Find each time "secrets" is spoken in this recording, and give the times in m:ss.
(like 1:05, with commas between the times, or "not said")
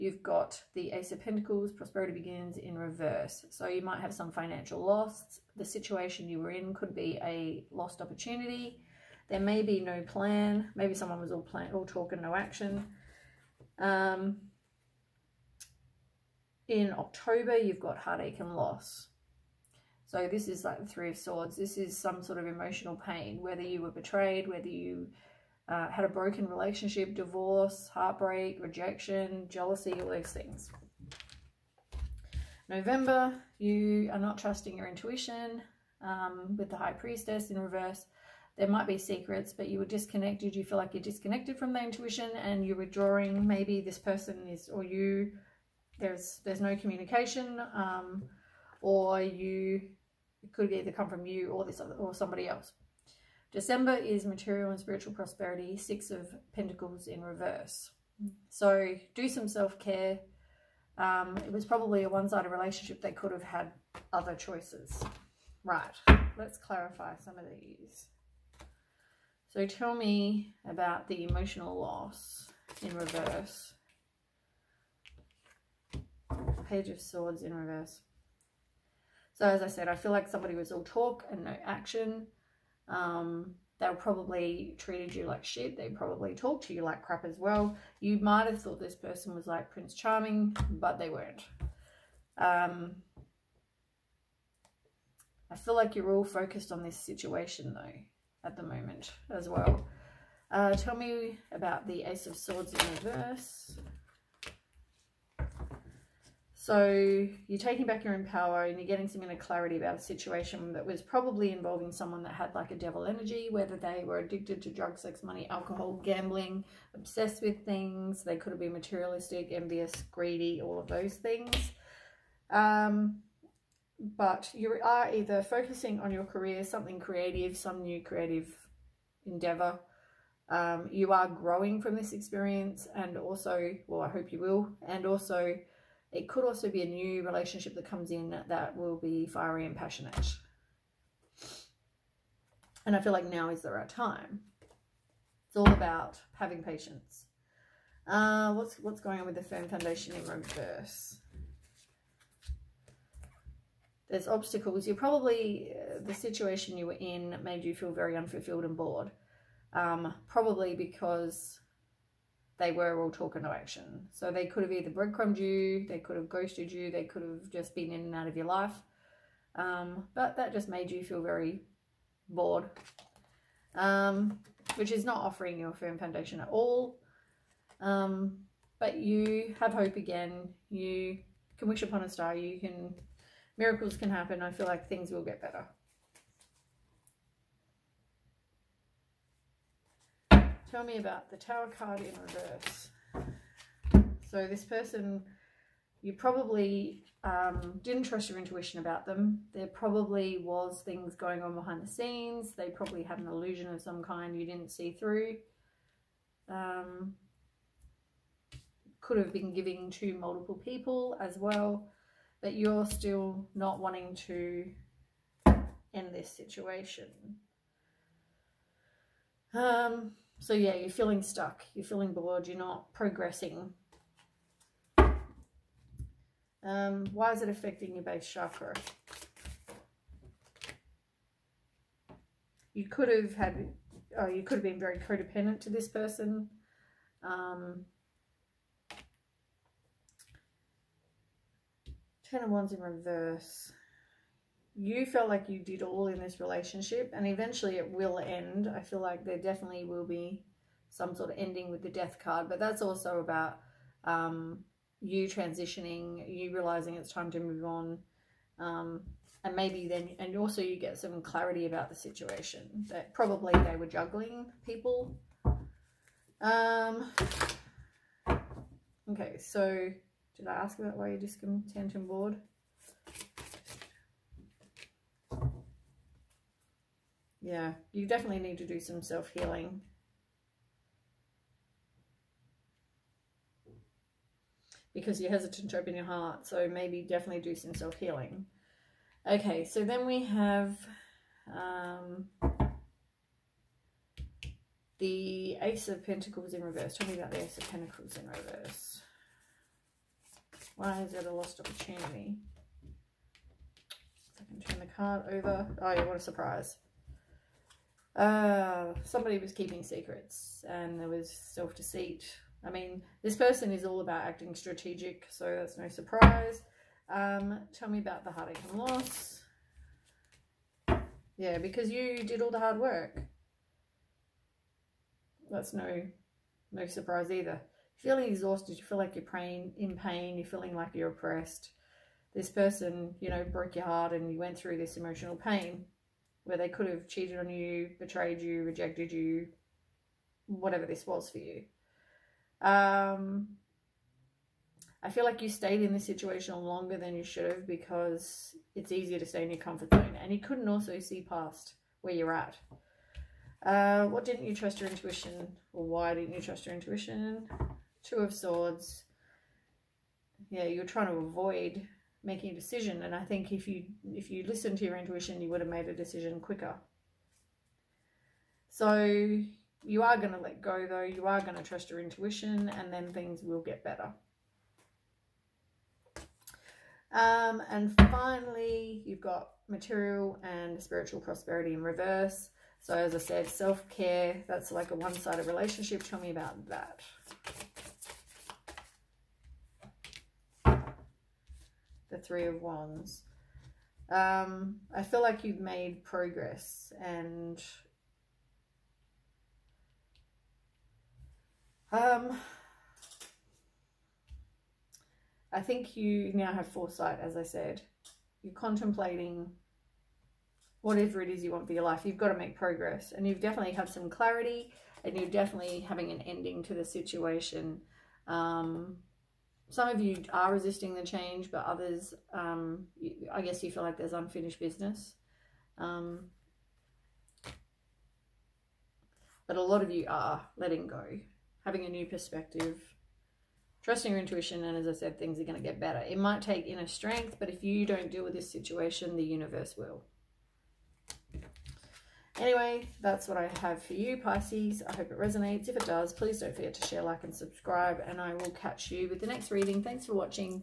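0:38, 5:09.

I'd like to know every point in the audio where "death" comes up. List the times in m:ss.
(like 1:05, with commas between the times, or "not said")
4:11.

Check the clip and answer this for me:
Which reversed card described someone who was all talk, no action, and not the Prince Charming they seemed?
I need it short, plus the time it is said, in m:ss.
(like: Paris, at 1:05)
Page of Swords, at 1:16.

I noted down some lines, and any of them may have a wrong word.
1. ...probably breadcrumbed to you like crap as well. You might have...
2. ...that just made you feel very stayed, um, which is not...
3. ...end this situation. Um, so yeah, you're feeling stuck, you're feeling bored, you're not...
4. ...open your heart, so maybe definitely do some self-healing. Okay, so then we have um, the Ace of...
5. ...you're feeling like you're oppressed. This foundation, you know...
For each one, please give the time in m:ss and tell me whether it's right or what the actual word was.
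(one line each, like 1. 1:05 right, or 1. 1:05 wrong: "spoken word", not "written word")
1. 1:25 wrong: "talked", not "breadcrumbed"
2. 2:50 wrong: "bored", not "stayed"
3. 3:35 right
4. 4:45 right
5. 5:30 wrong: "person", not "foundation".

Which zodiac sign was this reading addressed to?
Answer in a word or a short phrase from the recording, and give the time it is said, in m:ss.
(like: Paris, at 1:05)
Pisces, at 7:24.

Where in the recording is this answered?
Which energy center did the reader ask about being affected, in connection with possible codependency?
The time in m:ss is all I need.
3:48.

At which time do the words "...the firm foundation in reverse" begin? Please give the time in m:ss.
2:29.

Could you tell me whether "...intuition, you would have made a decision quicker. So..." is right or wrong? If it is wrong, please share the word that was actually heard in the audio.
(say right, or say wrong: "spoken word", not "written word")
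right.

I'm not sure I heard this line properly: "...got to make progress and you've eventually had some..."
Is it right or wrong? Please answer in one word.
wrong.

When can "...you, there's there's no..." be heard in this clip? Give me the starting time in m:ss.
0:44.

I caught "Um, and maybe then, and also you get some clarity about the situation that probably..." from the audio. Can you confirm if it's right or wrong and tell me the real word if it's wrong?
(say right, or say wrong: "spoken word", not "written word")
right.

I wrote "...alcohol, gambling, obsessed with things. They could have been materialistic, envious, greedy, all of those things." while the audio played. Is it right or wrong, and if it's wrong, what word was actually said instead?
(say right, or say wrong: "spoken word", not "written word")
right.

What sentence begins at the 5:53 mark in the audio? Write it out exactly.
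Uh, what didn't you trust your intuition?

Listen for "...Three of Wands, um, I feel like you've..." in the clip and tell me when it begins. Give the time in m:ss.
6:32.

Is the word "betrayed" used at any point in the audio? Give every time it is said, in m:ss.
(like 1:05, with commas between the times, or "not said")
0:23, 5:37.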